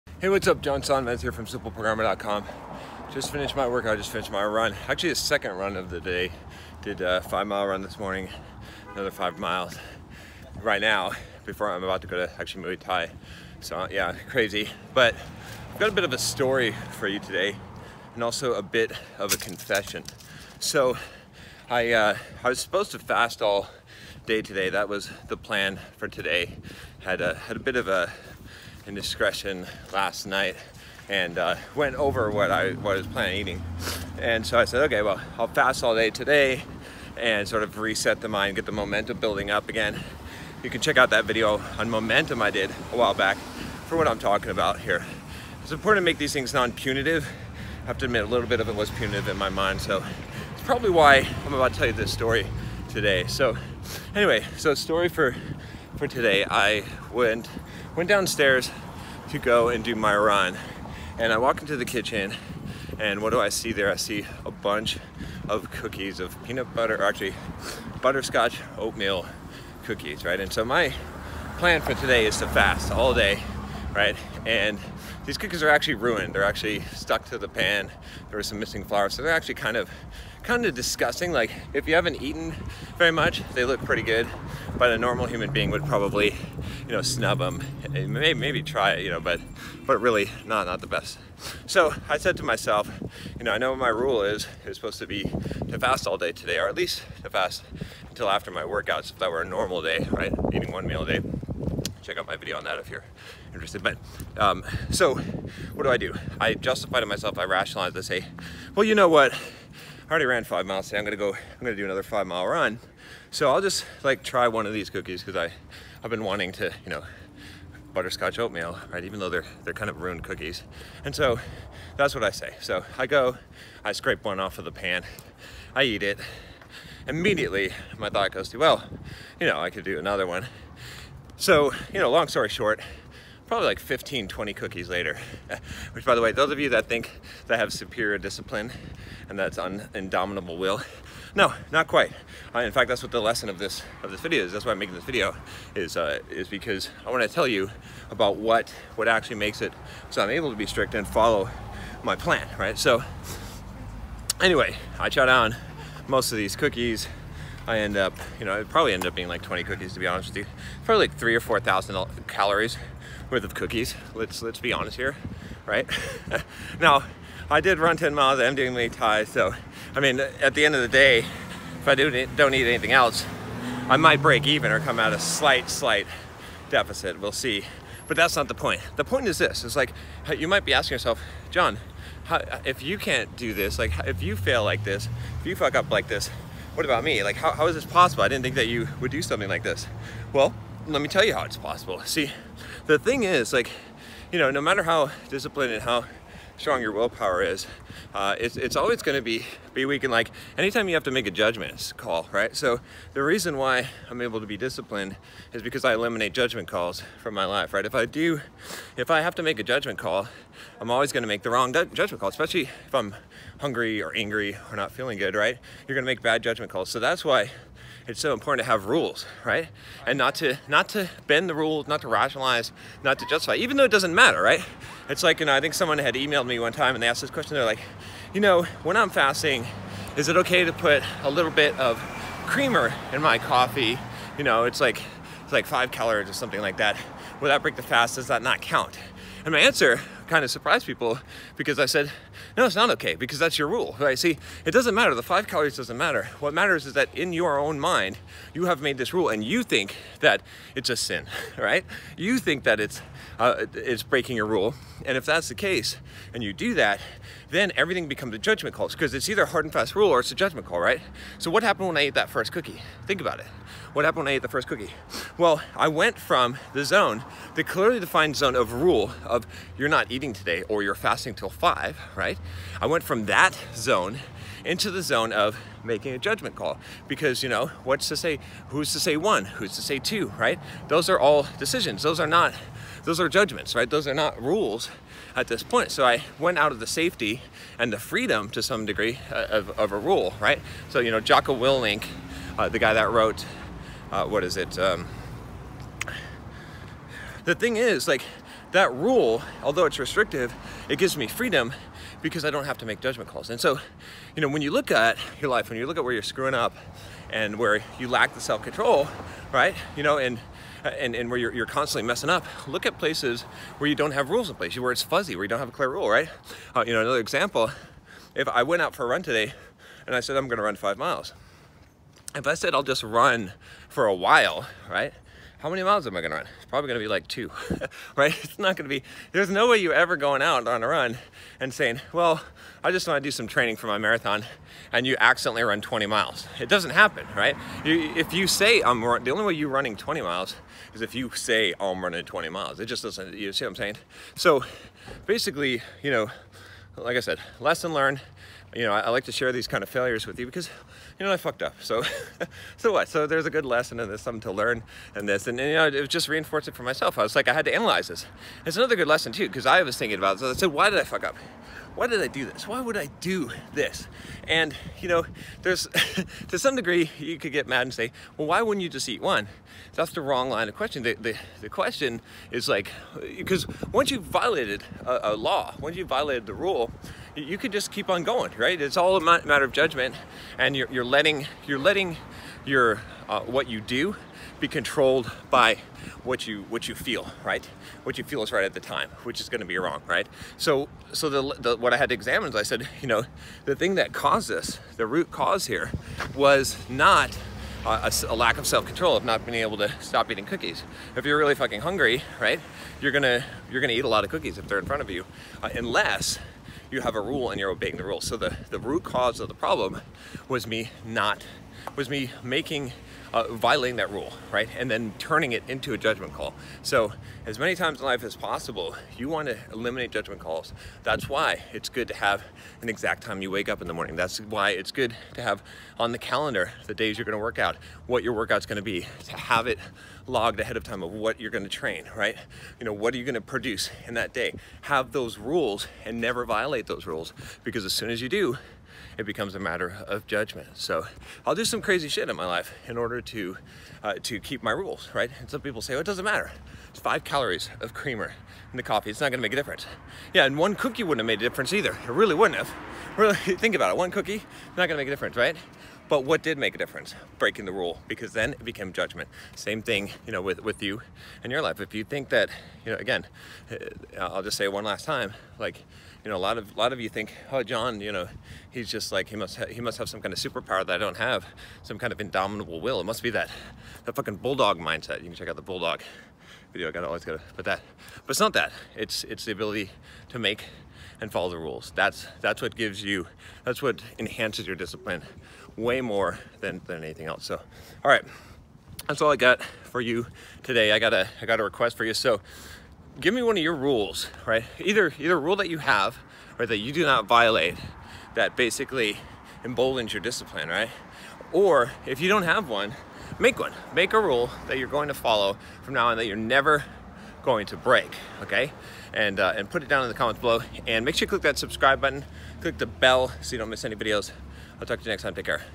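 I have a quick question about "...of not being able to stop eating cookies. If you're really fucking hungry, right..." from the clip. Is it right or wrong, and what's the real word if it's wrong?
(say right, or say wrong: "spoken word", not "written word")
right.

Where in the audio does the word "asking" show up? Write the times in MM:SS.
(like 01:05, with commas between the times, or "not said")
03:00.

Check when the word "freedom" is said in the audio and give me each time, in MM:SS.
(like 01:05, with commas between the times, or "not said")
04:47, 05:01.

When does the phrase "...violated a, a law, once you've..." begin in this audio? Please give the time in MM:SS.
06:14.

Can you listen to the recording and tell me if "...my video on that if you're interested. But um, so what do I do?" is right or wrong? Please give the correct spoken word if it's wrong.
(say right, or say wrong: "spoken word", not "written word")
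right.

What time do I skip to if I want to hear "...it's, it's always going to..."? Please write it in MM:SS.
03:18.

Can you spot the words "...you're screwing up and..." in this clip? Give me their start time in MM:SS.
05:06.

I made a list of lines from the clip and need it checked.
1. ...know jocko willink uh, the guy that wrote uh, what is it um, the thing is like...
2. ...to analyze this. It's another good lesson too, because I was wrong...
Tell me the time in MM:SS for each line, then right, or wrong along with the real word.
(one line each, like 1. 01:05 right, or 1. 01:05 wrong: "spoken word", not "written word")
1. 04:51 right
2. 05:57 wrong: "thinking", not "wrong".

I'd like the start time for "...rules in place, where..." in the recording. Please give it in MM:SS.
05:14.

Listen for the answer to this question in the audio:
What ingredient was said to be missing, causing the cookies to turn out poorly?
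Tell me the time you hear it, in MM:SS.
01:18.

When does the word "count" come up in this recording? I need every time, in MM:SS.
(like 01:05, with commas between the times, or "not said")
03:58.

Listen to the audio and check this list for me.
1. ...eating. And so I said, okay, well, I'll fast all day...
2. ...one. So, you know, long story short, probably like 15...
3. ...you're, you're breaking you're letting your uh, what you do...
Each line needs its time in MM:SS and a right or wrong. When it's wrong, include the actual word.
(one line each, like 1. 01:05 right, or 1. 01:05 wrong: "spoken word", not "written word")
1. 00:33 right
2. 02:10 right
3. 06:20 wrong: "letting", not "breaking".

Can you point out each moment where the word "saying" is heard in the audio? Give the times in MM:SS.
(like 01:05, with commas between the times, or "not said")
05:31, 05:43.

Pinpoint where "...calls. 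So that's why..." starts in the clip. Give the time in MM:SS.
03:36.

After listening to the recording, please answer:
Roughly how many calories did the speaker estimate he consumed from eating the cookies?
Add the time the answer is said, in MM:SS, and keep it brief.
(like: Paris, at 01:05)
3000 to 4000, at 02:41.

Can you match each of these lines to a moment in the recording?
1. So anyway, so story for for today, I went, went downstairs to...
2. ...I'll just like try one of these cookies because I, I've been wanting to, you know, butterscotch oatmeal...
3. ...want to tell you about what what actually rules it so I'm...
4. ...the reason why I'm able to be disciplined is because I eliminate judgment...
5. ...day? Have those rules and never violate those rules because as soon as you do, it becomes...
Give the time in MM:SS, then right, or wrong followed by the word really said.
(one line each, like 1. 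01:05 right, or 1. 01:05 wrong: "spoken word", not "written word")
1. 00:53 right
2. 01:53 right
3. 02:27 wrong: "makes", not "rules"
4. 03:23 right
5. 07:14 right.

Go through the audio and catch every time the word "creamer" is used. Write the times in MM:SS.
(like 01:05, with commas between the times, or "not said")
03:52, 07:27.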